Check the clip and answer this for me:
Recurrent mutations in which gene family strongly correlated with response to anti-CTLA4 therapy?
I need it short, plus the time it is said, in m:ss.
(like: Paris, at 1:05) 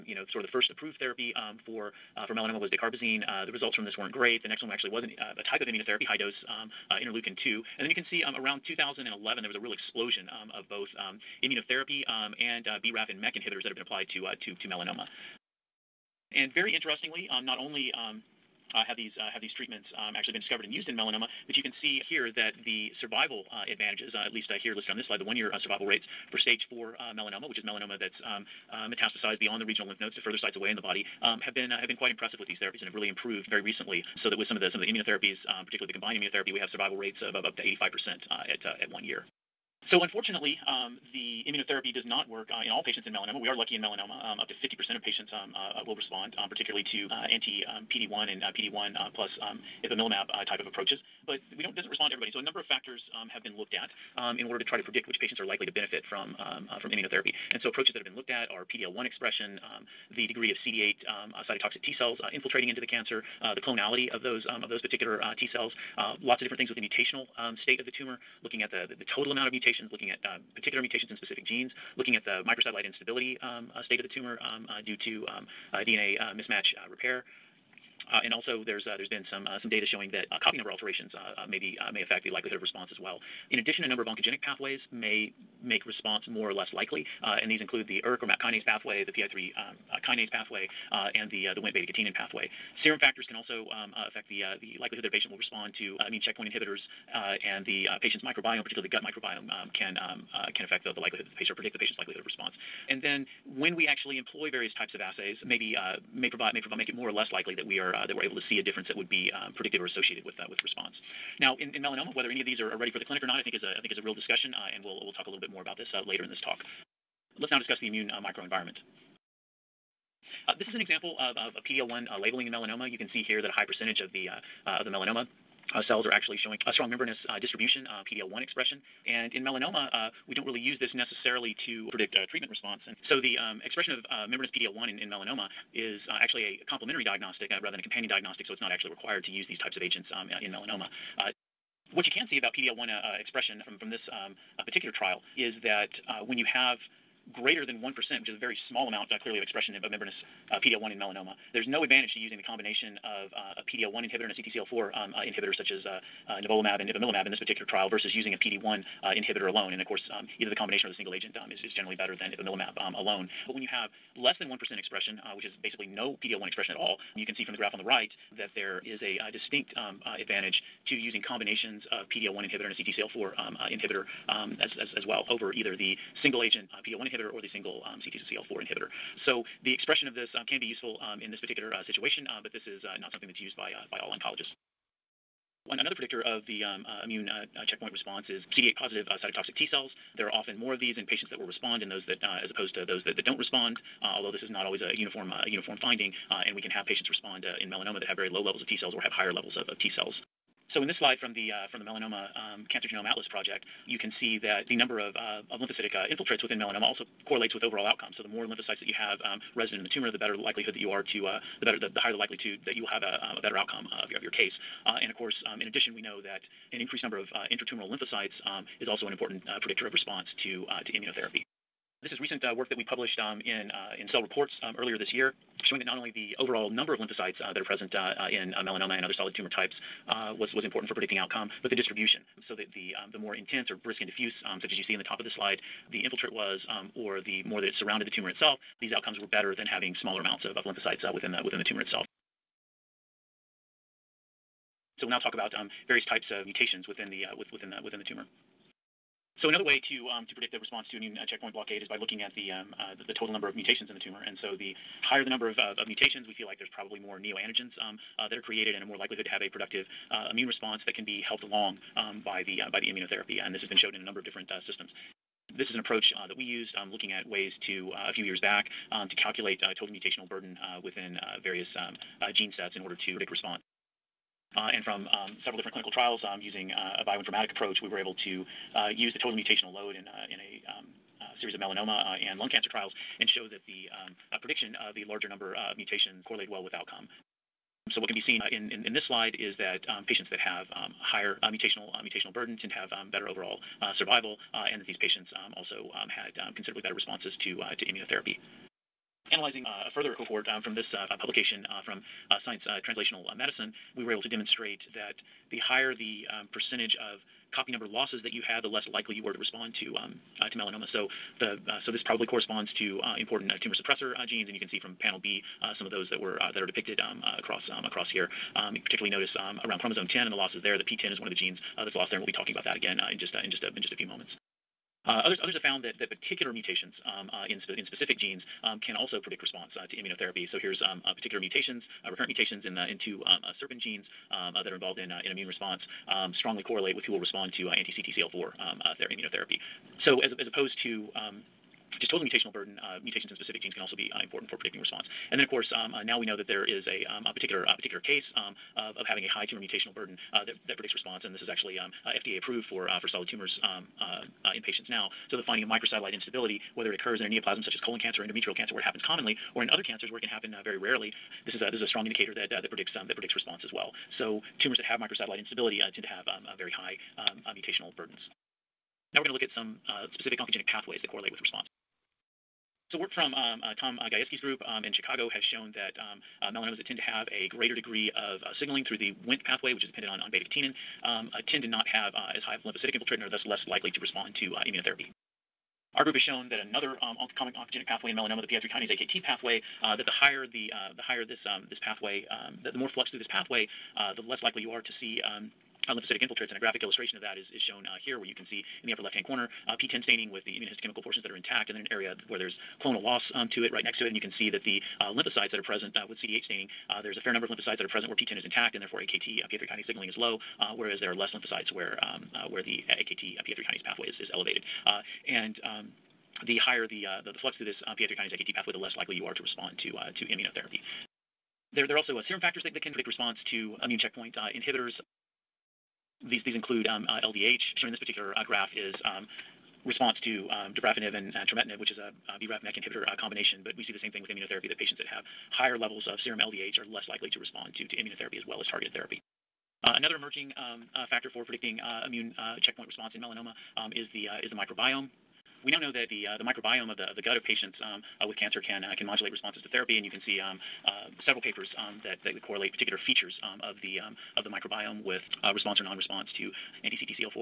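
SERPIN, at 5:33.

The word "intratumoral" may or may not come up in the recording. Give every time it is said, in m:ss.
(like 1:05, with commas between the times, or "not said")
3:37.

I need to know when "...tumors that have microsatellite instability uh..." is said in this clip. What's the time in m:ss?
6:04.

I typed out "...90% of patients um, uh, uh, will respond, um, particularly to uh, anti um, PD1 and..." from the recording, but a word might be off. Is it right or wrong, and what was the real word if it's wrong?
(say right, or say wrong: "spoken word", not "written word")
wrong: "50", not "90".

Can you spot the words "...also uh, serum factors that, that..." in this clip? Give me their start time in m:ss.
7:01.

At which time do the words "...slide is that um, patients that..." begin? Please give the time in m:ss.
4:49.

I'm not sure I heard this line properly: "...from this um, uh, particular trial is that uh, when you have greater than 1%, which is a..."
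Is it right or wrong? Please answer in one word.
right.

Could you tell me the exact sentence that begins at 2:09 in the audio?
And in melanoma, uh, we don't really use this necessarily to predict treatment response.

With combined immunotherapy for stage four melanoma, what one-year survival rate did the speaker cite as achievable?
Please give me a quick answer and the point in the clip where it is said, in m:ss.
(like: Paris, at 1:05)
85 percent, at 0:37.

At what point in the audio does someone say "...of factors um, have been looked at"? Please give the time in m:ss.
0:52.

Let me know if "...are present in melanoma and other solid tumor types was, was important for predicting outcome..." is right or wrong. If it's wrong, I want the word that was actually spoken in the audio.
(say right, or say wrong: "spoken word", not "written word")
right.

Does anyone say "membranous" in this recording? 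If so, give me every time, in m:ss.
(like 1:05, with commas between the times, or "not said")
2:06, 2:14, 2:29.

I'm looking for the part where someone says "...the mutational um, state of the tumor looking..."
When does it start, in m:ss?
1:06.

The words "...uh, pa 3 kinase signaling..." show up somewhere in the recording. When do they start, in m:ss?
6:49.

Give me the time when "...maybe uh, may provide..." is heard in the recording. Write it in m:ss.
1:45.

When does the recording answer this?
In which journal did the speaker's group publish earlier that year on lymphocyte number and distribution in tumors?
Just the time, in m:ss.
3:44.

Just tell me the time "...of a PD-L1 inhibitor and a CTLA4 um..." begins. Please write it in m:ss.
2:33.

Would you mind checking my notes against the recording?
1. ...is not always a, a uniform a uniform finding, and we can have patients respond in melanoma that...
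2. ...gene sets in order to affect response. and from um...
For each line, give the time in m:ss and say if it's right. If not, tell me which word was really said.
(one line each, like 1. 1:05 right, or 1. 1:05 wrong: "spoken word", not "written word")
1. 3:14 right
2. 4:32 wrong: "predict", not "affect".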